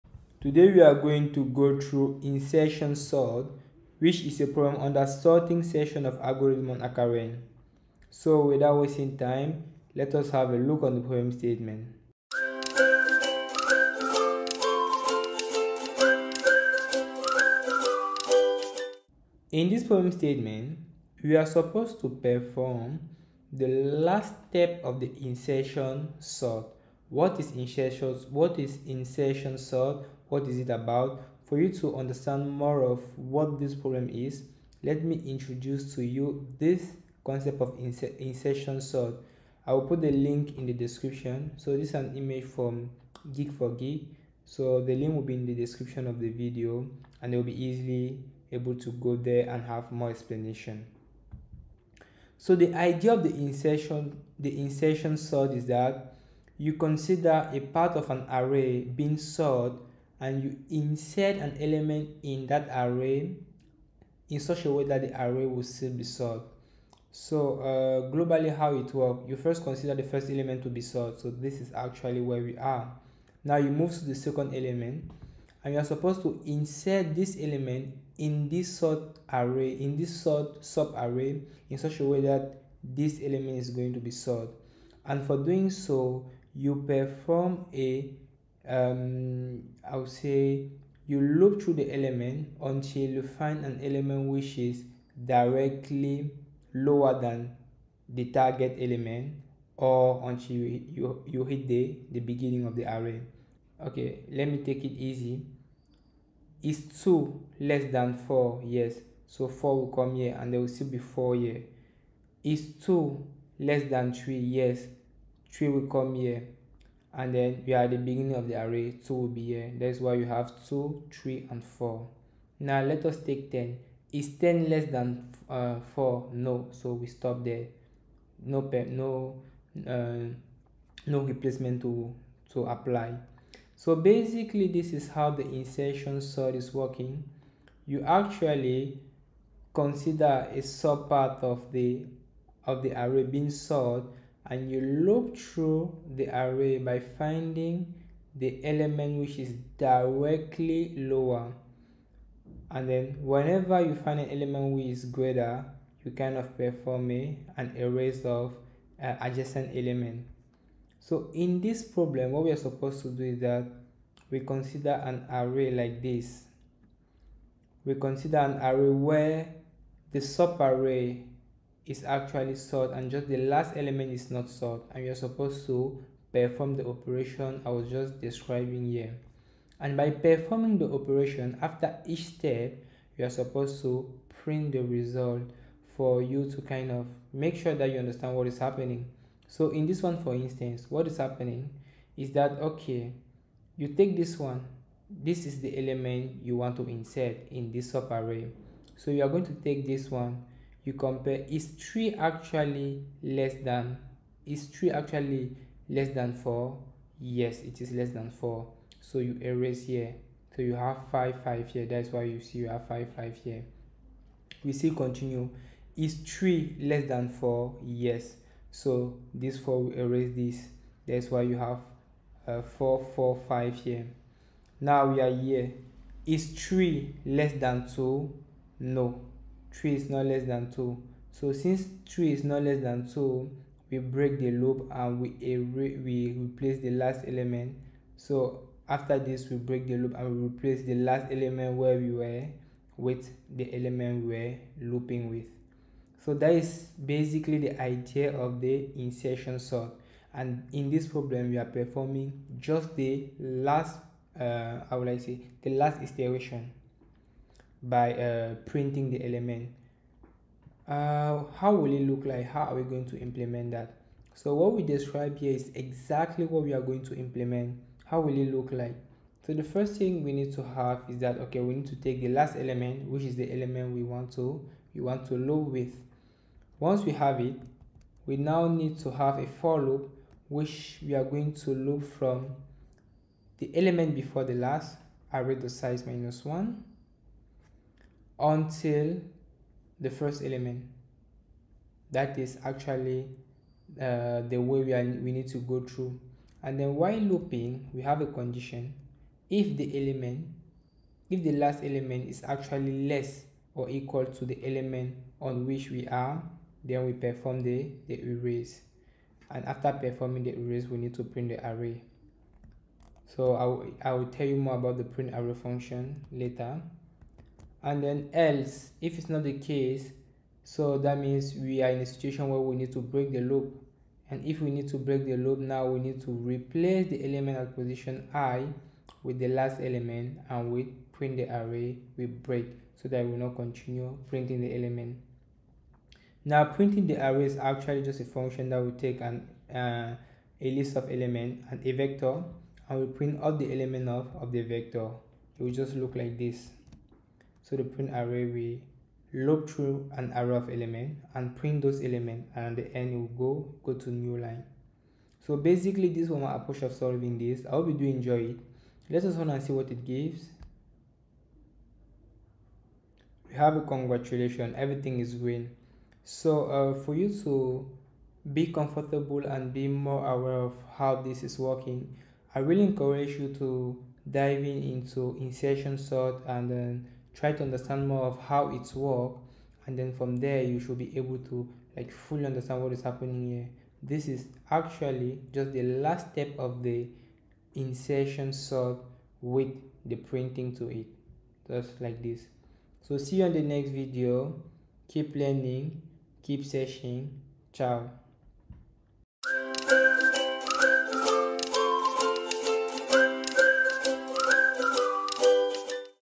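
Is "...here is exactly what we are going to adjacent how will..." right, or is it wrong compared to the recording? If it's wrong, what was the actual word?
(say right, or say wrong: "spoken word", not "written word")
wrong: "implement", not "adjacent".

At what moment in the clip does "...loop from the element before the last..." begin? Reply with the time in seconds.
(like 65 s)
281 s.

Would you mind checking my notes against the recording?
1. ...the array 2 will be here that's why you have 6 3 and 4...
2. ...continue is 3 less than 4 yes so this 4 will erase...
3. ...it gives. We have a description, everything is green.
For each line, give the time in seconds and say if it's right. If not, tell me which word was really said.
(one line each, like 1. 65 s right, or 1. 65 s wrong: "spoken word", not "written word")
1. 118 s wrong: "2", not "6"
2. 214 s right
3. 359 s wrong: "congratulation", not "description".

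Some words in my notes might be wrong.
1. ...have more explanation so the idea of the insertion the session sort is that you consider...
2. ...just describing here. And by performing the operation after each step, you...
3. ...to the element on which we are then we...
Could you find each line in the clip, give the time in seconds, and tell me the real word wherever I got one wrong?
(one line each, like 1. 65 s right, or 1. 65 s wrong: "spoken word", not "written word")
1. 49 s wrong: "insertion", not "session"
2. 177 s right
3. 304 s right.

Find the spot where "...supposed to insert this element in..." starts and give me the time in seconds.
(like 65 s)
75 s.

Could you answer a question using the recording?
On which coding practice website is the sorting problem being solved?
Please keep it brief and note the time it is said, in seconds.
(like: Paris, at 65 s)
HackerRank, at 6 s.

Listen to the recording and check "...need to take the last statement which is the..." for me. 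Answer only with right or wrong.
wrong.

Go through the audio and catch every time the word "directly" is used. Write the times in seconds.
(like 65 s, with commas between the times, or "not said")
95 s, 149 s.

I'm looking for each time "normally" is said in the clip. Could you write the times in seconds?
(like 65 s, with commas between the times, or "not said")
not said.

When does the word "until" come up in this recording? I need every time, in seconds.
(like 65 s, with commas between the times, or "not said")
92 s, 100 s, 288 s.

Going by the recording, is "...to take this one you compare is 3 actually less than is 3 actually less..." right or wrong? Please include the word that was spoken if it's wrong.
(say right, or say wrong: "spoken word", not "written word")
right.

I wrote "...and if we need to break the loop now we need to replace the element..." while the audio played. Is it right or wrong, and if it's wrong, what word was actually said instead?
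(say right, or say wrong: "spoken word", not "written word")
right.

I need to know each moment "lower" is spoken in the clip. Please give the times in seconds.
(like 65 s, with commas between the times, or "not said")
96 s, 150 s.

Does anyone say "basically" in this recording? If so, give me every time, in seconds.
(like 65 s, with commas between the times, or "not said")
133 s, 247 s, 355 s.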